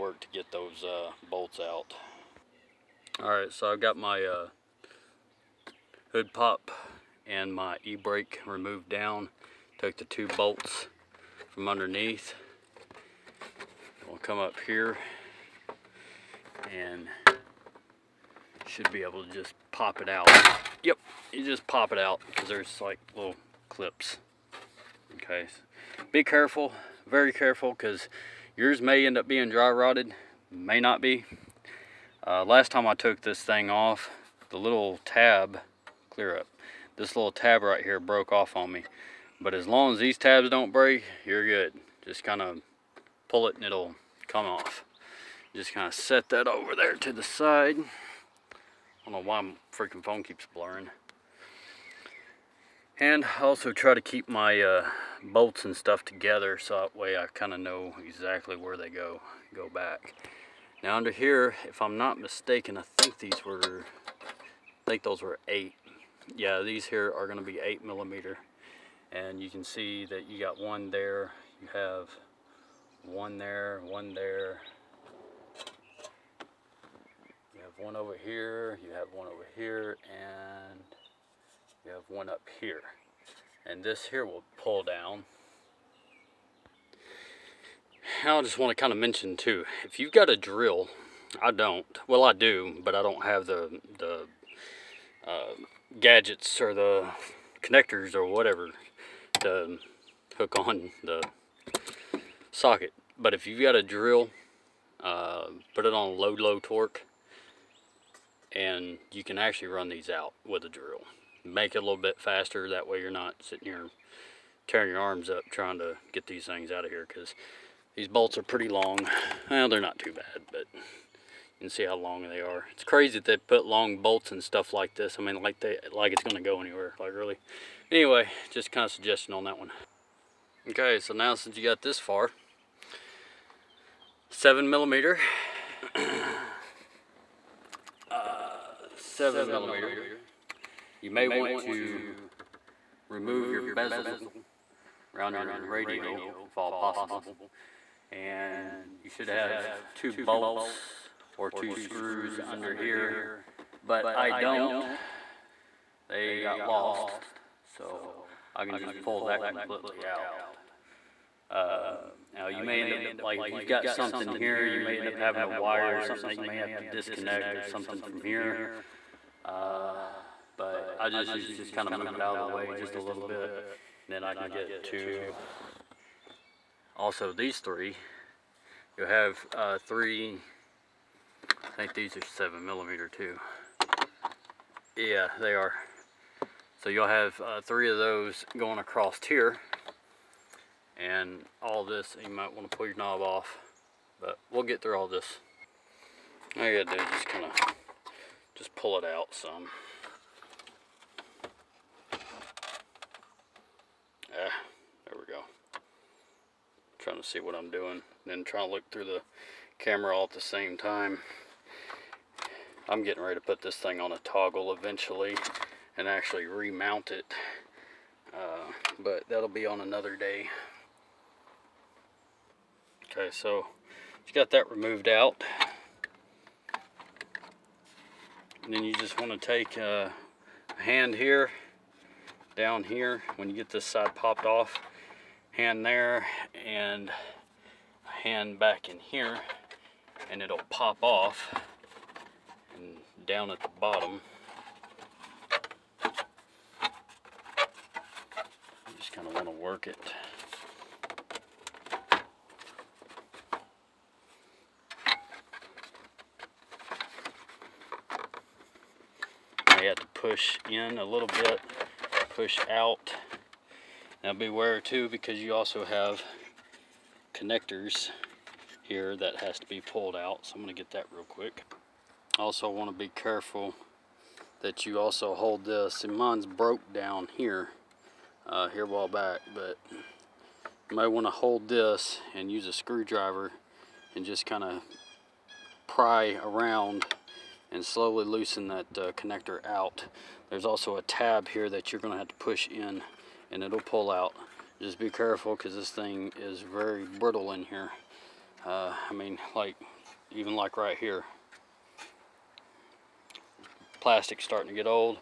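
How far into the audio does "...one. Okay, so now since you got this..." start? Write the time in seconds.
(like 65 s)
129 s.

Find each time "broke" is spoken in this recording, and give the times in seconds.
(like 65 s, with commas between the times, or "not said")
37 s, 276 s.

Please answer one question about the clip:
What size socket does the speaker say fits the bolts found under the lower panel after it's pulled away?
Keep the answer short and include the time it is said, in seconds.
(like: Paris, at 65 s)
8 millimeter, at 67 s.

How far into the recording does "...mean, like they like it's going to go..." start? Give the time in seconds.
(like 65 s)
125 s.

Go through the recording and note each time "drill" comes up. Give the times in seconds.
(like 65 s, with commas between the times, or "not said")
90 s, 103 s, 110 s.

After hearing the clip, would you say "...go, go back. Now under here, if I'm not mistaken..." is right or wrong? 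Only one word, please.
right.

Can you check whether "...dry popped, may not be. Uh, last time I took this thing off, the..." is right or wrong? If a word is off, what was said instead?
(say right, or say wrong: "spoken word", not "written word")
wrong: "rotted", not "popped".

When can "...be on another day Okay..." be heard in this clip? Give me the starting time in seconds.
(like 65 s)
219 s.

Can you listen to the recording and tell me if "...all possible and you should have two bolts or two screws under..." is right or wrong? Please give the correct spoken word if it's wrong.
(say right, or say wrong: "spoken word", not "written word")
right.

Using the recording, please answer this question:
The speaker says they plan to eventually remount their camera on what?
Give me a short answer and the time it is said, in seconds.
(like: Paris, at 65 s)
a toggle, at 214 s.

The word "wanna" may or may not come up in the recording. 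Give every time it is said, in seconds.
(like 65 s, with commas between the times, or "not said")
272 s, 281 s.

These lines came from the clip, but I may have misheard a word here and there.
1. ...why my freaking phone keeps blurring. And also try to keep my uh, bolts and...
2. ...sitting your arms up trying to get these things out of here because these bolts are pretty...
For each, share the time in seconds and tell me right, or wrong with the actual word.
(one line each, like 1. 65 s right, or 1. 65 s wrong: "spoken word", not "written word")
1. 49 s right
2. 114 s wrong: "tearing", not "sitting".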